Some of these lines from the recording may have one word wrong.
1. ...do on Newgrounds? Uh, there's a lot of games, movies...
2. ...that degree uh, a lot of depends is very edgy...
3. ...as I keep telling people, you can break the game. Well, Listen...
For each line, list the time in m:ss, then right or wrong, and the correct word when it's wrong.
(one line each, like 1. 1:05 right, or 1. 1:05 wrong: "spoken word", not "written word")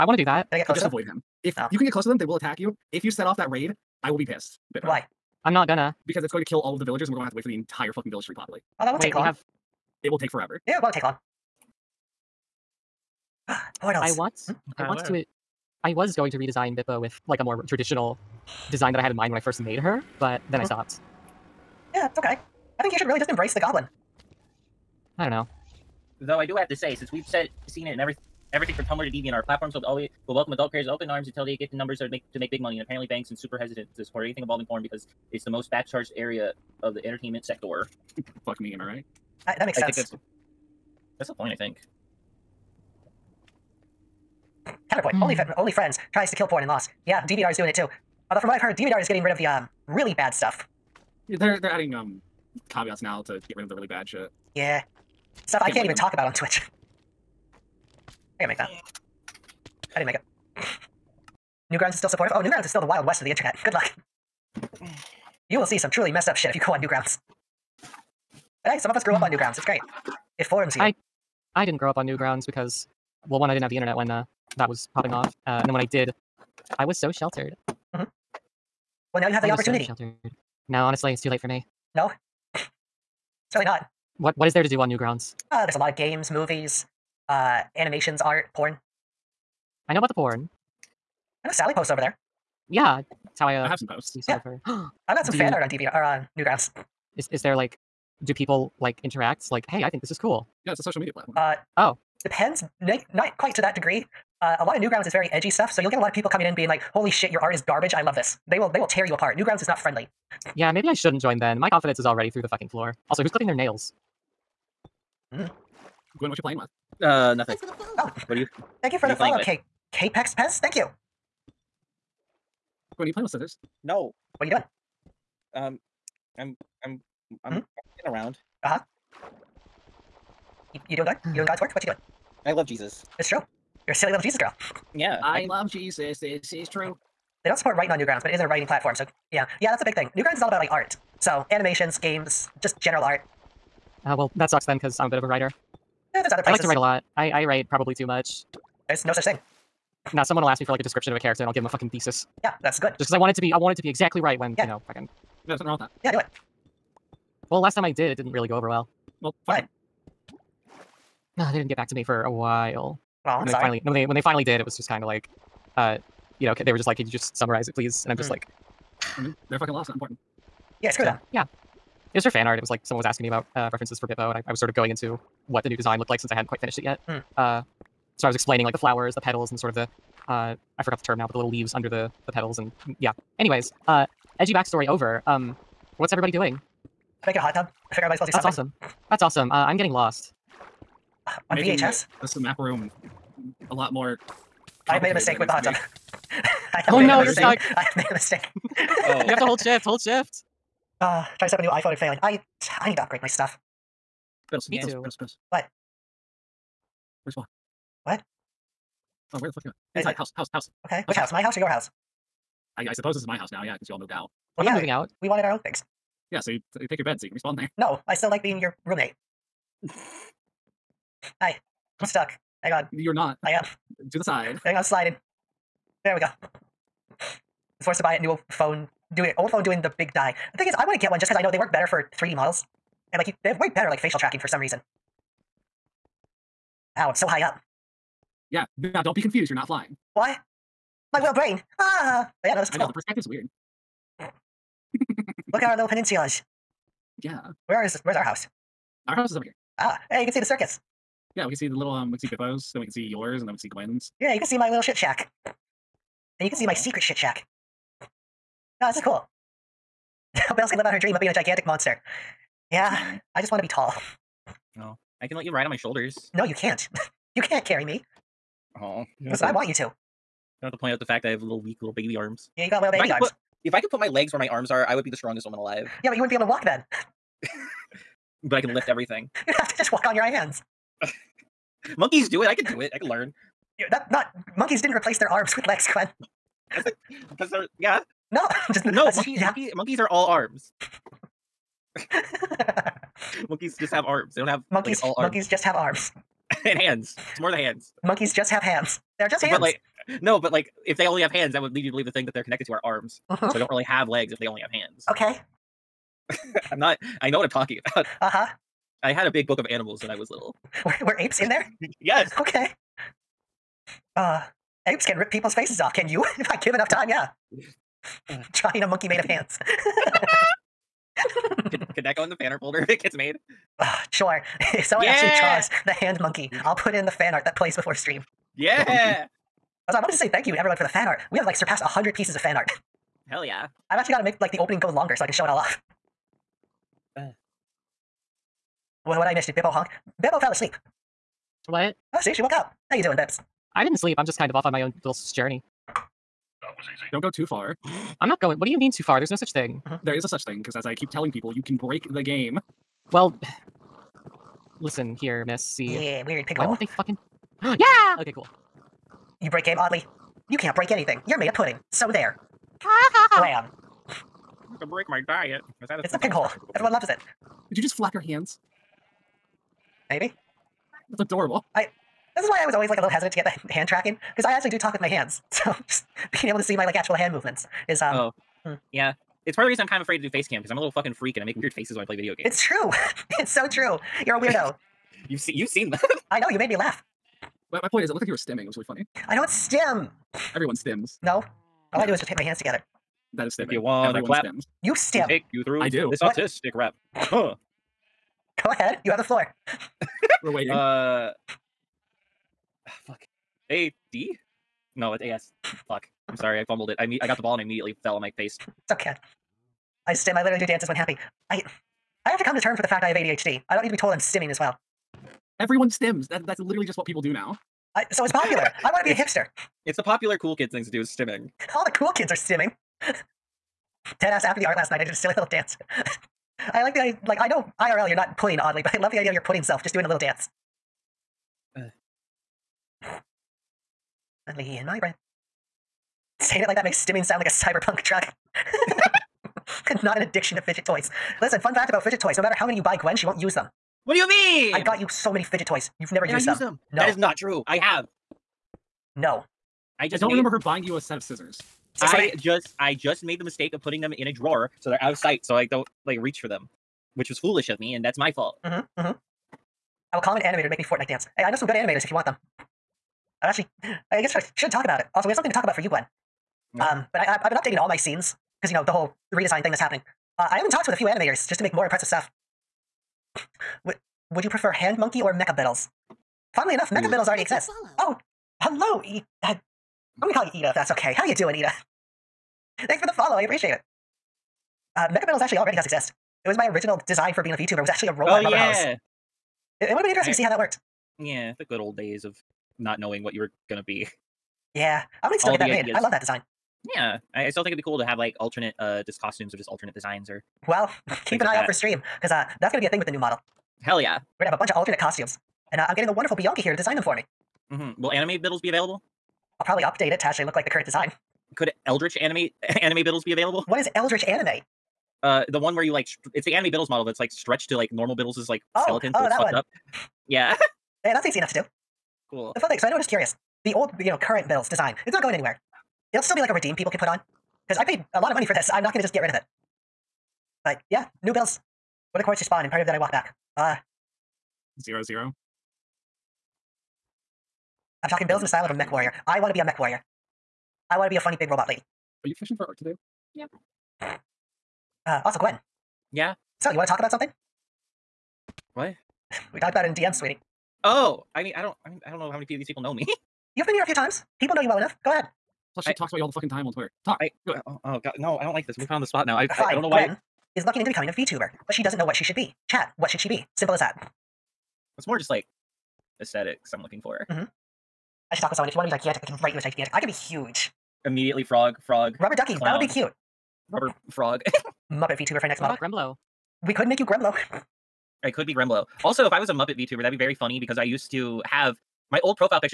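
1. 1:24 right
2. 1:43 wrong: "newgrounds", not "depends"
3. 5:50 right.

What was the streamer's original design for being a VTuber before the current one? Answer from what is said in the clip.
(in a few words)
A robot.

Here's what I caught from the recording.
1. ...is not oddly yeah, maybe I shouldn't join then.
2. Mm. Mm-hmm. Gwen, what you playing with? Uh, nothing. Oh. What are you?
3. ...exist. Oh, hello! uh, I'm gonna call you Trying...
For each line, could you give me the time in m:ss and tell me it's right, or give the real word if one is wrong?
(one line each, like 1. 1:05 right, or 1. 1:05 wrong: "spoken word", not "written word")
1. 1:49 wrong: "friendly", not "oddly"
2. 1:55 right
3. 7:57 wrong: "Ida", not "Trying".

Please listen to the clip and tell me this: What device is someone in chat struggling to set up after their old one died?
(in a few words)
A new iPhone.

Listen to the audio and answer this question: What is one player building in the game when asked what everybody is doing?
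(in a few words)
A hot tub.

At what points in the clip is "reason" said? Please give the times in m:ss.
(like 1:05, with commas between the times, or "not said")
3:54, 6:19.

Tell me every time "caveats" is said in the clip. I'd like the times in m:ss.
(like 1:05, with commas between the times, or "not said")
0:52.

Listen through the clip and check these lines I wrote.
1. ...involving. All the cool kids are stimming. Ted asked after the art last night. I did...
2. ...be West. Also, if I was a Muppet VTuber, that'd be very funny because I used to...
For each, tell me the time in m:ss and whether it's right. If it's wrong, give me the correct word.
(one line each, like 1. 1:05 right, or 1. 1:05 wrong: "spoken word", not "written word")
1. 7:01 wrong: "stimming", not "involving"
2. 9:38 wrong: "Gremblo", not "West".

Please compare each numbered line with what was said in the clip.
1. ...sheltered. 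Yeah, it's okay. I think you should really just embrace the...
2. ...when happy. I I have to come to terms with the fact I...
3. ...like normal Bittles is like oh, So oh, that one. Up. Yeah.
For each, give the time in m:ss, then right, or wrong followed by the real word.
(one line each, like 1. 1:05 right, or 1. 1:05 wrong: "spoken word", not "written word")
1. 0:20 wrong: "stopped", not "sheltered"
2. 6:50 right
3. 8:37 right.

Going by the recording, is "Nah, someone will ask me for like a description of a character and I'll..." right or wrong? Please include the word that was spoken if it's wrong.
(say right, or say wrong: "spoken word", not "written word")
right.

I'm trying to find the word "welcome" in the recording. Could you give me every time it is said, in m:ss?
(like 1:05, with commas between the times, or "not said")
0:30.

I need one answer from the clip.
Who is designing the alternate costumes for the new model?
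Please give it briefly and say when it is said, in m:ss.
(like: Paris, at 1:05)
Bianca, at 8:26.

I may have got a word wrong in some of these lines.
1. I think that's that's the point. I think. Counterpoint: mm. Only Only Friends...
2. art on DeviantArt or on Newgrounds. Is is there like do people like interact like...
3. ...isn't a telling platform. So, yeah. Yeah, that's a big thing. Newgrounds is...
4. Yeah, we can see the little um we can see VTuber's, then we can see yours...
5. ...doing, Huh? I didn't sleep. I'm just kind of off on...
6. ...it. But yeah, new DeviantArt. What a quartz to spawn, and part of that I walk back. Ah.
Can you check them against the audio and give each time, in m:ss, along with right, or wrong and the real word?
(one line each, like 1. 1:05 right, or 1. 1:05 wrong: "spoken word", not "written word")
1. 0:39 right
2. 1:35 right
3. 2:18 wrong: "writing", not "telling"
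4. 4:11 wrong: "Bippo", not "VTuber"
5. 5:43 wrong: "Bips", not "Huh"
6. 8:49 wrong: "Bittles", not "DeviantArt".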